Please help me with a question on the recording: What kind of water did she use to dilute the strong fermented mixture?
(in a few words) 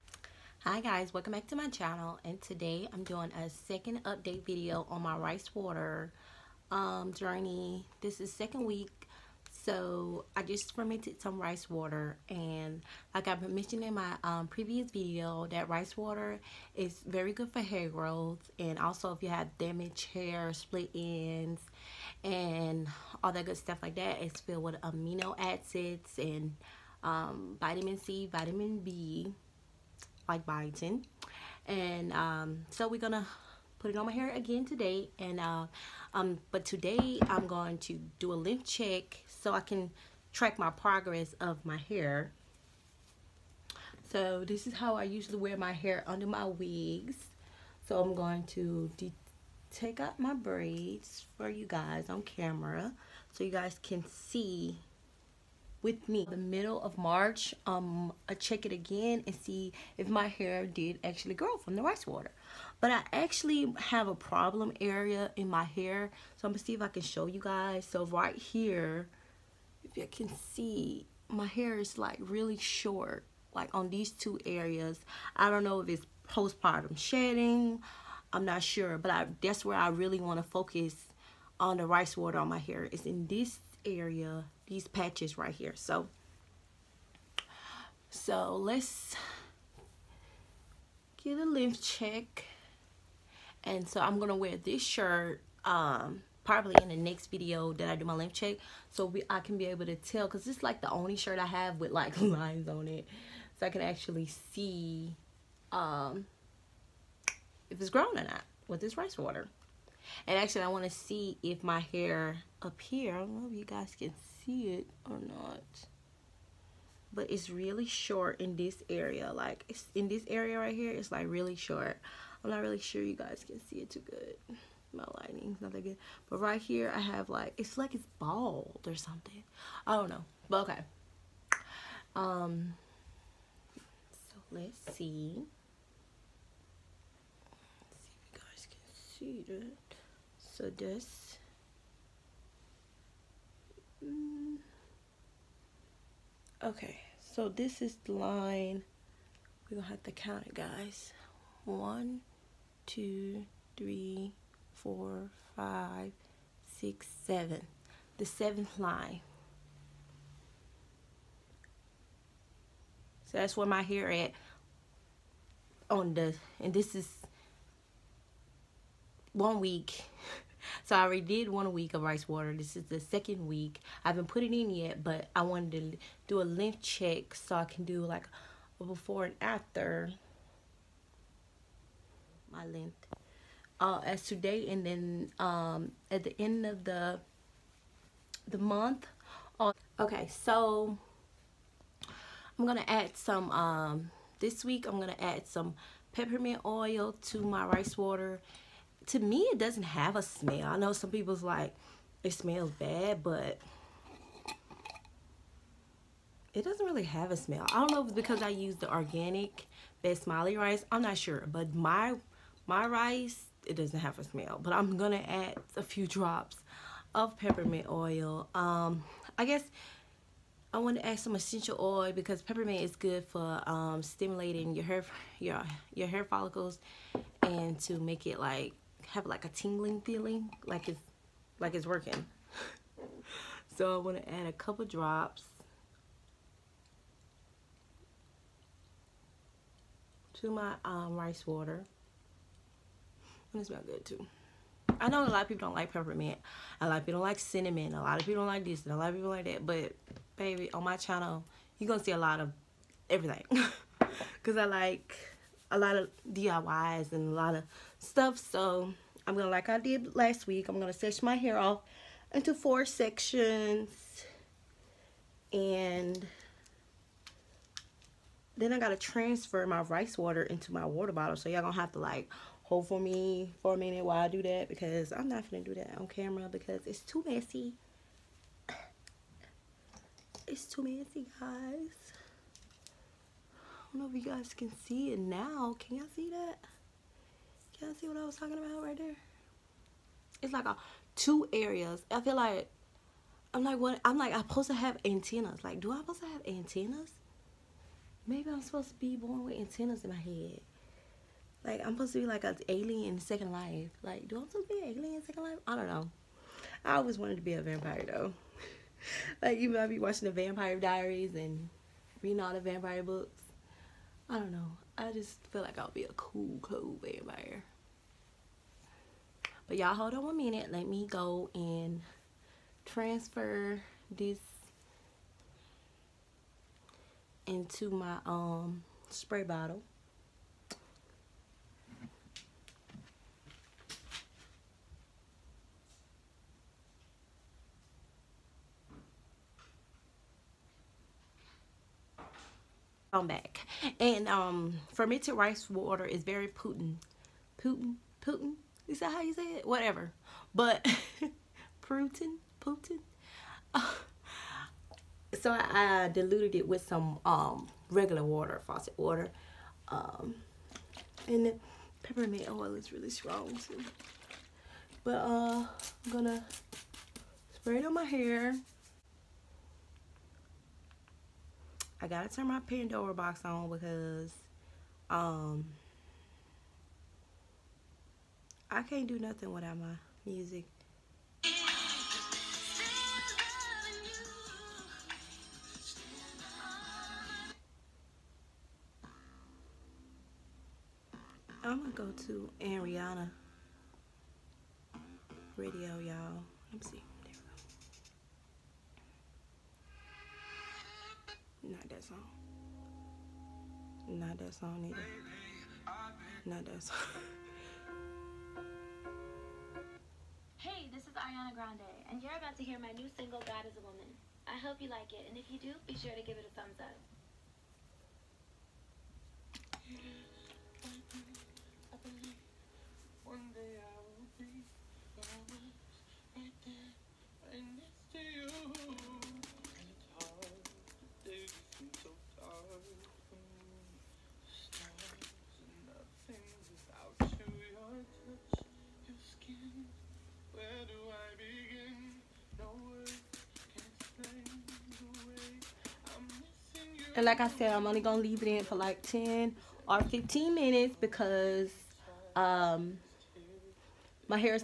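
Faucet water.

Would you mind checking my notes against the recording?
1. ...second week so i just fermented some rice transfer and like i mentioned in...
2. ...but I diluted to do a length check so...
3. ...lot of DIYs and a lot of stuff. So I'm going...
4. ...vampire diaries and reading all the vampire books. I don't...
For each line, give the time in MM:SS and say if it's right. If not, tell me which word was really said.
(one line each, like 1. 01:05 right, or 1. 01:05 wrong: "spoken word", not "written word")
1. 00:08 wrong: "water", not "transfer"
2. 02:55 wrong: "wanted", not "diluted"
3. 04:15 right
4. 05:10 right.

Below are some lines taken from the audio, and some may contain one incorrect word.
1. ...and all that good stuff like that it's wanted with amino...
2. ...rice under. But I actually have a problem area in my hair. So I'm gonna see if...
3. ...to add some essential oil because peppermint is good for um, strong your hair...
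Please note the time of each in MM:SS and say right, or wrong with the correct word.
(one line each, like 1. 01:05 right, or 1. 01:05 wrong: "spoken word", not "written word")
1. 00:22 wrong: "filled", not "wanted"
2. 01:01 wrong: "water", not "under"
3. 03:40 wrong: "stimulating", not "strong".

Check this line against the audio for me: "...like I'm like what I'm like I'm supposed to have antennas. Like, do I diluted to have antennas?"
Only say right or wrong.
wrong.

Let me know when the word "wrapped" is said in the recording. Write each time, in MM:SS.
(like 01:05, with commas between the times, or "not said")
not said.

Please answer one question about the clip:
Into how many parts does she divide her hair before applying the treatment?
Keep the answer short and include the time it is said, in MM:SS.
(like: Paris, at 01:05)
4 sections, at 04:22.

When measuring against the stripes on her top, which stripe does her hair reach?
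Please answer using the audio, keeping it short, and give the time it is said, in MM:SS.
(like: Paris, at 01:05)
7th line, at 02:38.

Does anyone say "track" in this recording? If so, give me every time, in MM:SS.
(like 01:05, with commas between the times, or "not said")
00:40.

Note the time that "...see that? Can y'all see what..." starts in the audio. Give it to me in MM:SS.
04:46.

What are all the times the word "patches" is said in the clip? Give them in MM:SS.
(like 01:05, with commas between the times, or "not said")
01:24.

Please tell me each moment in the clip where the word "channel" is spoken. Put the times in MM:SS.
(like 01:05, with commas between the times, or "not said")
00:01, 04:10.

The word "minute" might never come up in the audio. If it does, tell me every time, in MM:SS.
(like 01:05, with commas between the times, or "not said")
04:33, 05:20, 07:30.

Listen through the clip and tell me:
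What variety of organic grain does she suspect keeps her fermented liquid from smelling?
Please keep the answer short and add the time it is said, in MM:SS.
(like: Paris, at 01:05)
Basmati rice, at 03:28.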